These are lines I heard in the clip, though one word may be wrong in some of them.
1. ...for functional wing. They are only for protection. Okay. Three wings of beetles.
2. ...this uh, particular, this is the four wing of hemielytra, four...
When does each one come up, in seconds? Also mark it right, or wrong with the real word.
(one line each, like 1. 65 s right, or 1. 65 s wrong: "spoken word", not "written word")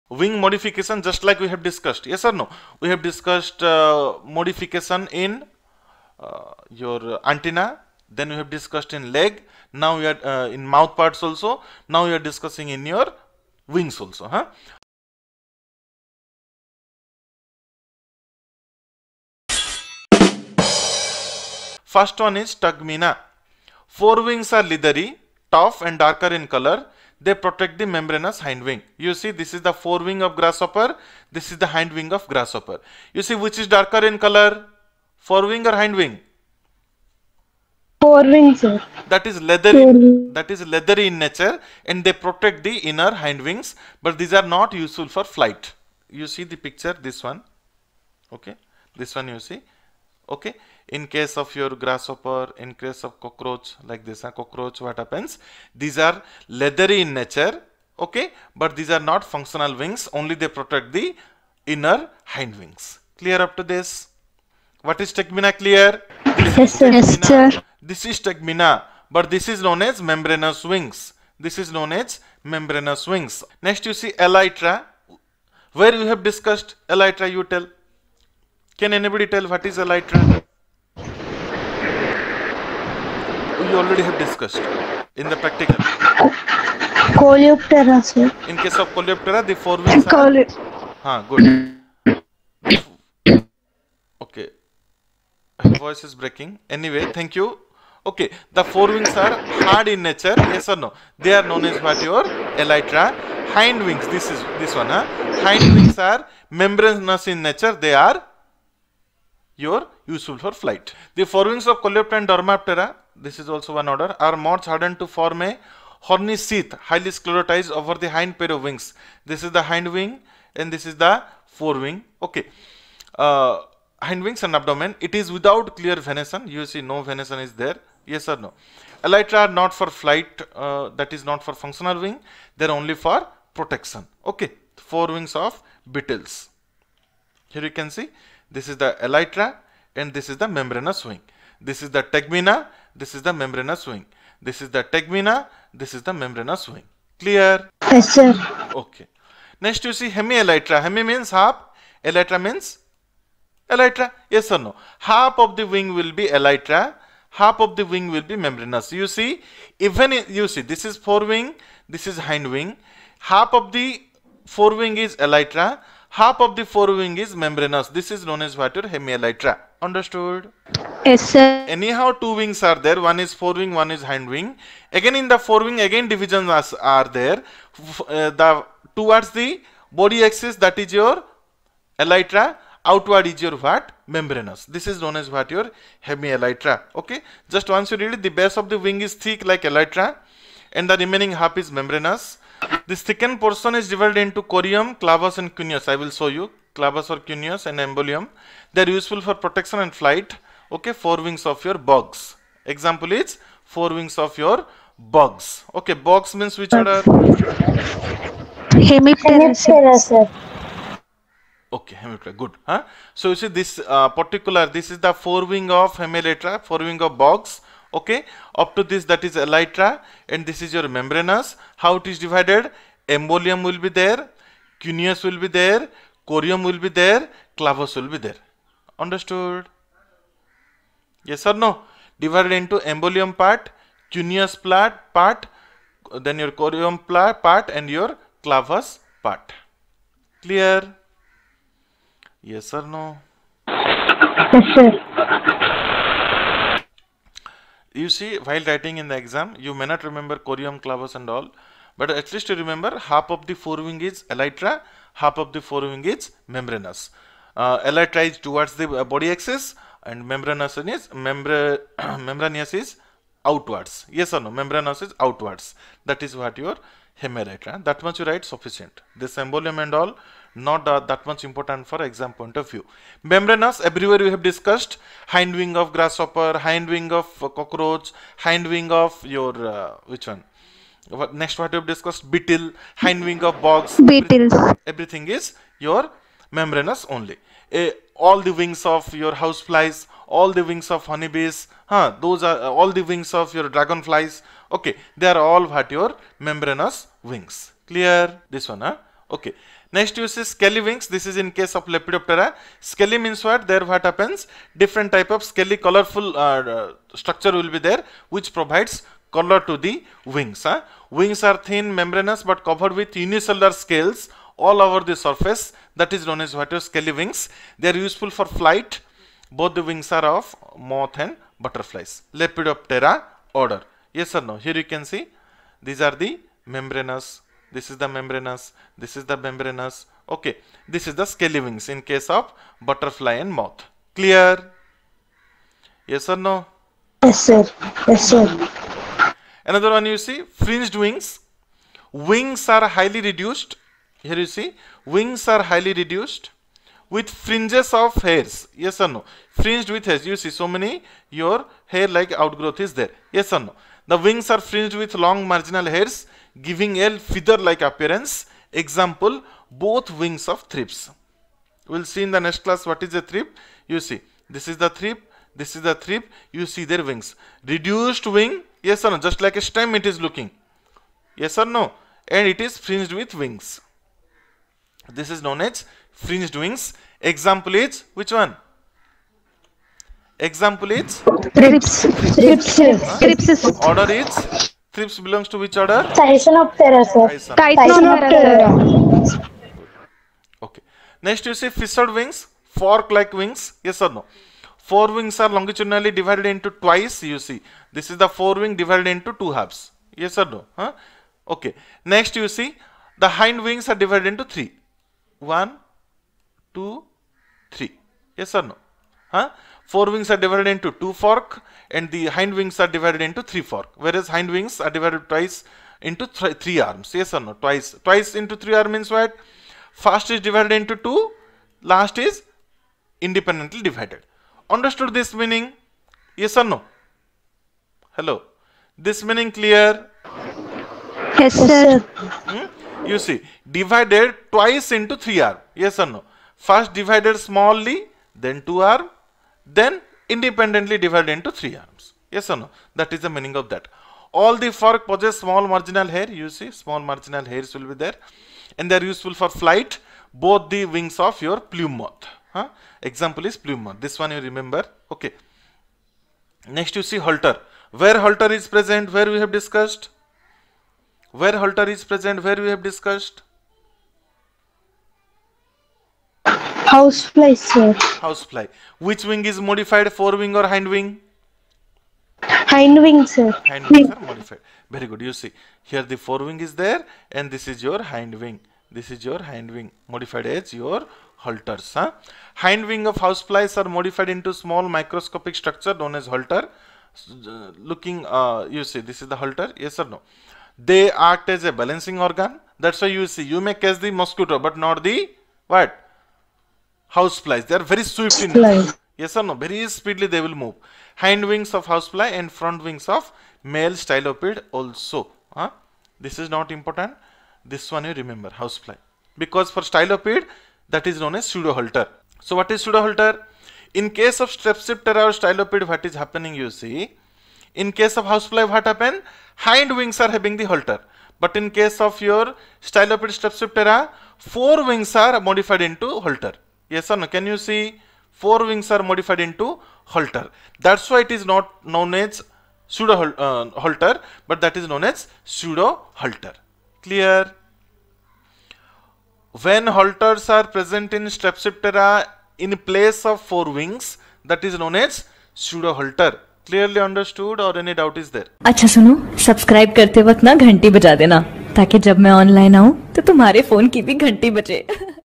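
1. 131 s wrong: "Four", not "Three"
2. 213 s right.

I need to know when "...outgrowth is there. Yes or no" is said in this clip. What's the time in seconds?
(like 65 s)
352 s.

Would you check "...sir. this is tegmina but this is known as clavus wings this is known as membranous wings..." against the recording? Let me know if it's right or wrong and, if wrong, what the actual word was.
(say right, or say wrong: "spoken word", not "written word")
wrong: "membranous", not "clavus".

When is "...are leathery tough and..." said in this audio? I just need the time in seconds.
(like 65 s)
24 s.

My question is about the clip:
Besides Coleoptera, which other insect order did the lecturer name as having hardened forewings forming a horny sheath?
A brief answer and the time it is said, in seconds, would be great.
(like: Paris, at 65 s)
Dermaptera, at 112 s.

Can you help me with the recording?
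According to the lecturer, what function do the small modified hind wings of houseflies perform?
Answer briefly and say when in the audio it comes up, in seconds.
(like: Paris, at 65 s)
balancing organ, at 491 s.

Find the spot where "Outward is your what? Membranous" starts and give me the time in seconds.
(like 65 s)
182 s.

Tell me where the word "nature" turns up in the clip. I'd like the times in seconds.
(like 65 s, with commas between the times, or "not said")
41 s, 57 s, 100 s, 107 s.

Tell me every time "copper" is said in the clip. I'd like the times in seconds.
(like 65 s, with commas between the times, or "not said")
not said.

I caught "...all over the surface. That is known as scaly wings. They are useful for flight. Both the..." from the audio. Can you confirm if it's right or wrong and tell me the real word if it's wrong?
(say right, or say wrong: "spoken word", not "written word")
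right.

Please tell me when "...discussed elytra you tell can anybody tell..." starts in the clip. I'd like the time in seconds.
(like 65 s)
76 s.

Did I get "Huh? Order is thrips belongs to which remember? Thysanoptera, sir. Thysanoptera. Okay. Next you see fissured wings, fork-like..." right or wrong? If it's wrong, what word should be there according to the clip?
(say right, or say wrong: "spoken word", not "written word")
wrong: "order", not "remember".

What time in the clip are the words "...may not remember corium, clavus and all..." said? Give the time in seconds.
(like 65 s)
249 s.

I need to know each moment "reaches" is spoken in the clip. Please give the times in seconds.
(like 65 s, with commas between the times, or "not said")
not said.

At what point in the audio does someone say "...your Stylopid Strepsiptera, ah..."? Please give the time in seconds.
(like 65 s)
522 s.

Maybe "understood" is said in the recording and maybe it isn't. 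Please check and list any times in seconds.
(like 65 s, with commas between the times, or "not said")
169 s, 228 s, 424 s, 547 s.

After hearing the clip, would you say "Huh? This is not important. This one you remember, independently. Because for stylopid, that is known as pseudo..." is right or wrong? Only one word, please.
wrong.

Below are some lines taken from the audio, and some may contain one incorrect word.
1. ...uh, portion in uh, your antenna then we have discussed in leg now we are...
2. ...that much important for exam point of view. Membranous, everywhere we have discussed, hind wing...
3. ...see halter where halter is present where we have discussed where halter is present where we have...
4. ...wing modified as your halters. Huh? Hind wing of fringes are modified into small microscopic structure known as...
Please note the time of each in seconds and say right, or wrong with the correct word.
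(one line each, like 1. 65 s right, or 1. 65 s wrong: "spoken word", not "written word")
1. 3 s wrong: "modification", not "portion"
2. 271 s right
3. 457 s right
4. 479 s wrong: "houseflies", not "fringes".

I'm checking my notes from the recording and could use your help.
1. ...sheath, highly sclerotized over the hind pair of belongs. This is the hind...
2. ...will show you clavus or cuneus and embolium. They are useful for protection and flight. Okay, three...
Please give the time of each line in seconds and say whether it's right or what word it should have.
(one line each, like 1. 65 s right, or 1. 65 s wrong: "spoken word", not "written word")
1. 116 s wrong: "wings", not "belongs"
2. 196 s wrong: "four", not "three".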